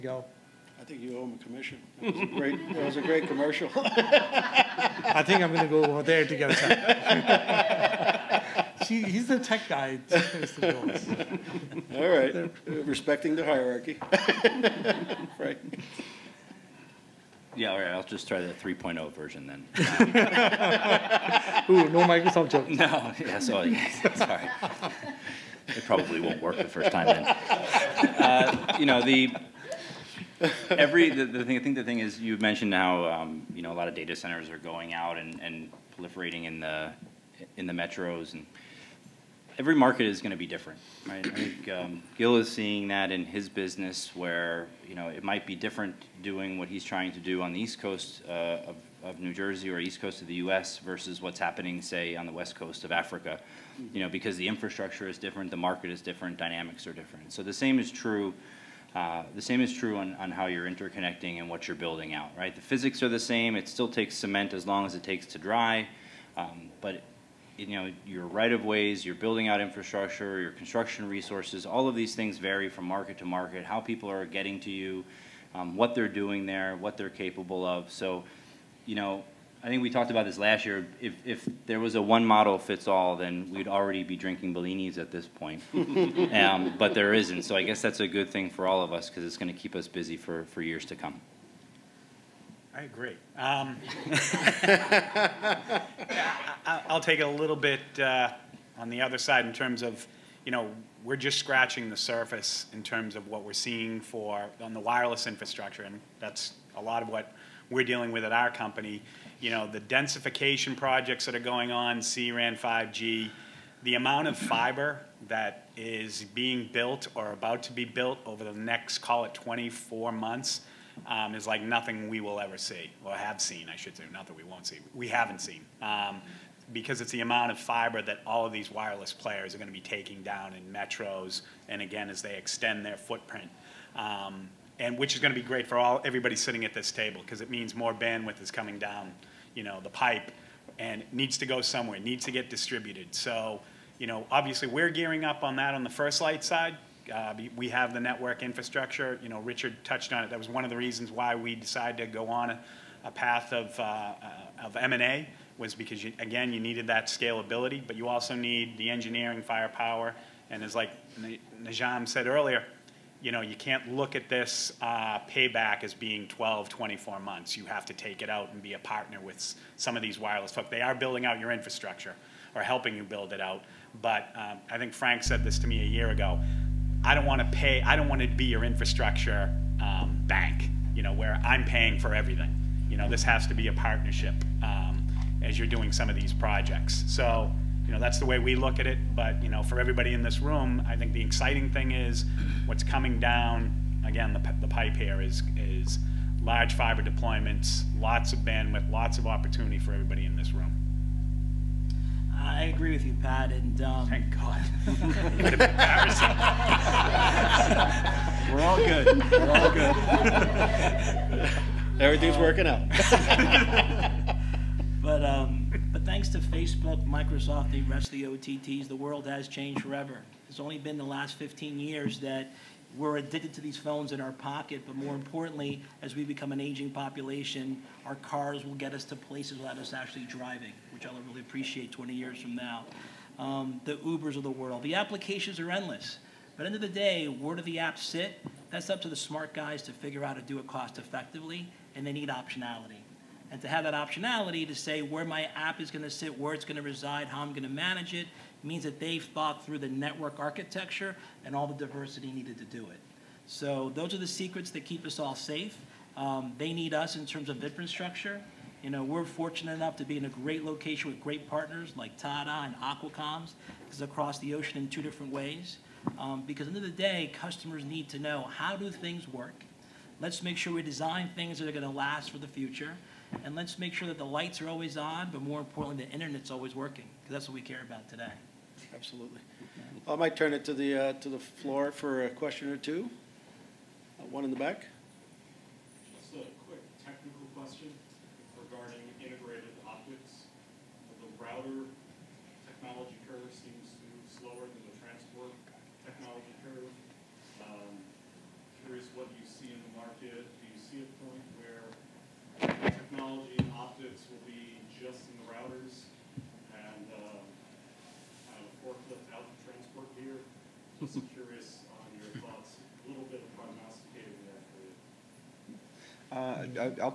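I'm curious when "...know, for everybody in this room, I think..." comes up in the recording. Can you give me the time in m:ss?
3:09.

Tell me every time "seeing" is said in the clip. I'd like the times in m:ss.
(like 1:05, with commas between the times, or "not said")
0:42, 1:43.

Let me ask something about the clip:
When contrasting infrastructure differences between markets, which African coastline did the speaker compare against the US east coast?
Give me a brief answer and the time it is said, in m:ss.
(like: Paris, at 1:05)
West coast of Africa, at 0:52.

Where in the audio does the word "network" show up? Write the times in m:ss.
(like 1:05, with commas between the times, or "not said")
2:27, 4:09.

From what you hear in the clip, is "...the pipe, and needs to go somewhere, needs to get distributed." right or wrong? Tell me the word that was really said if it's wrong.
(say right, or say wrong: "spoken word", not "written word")
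right.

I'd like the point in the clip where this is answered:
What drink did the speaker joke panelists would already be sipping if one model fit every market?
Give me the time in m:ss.
1:24.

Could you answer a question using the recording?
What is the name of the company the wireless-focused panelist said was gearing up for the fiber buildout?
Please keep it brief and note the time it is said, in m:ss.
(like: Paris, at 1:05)
FirstLight, at 2:25.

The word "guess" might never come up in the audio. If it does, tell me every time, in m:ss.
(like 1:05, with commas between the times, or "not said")
1:27.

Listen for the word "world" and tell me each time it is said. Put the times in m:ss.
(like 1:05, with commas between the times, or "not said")
3:38, 3:54.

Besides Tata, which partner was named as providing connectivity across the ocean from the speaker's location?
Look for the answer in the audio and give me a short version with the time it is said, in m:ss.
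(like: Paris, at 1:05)
Aqua Comms, at 4:22.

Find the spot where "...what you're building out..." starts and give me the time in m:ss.
1:01.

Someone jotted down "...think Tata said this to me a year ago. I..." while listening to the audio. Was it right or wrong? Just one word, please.
wrong.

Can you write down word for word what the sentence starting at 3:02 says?
You know, this has to be a partnership um, as you're doing some of these projects.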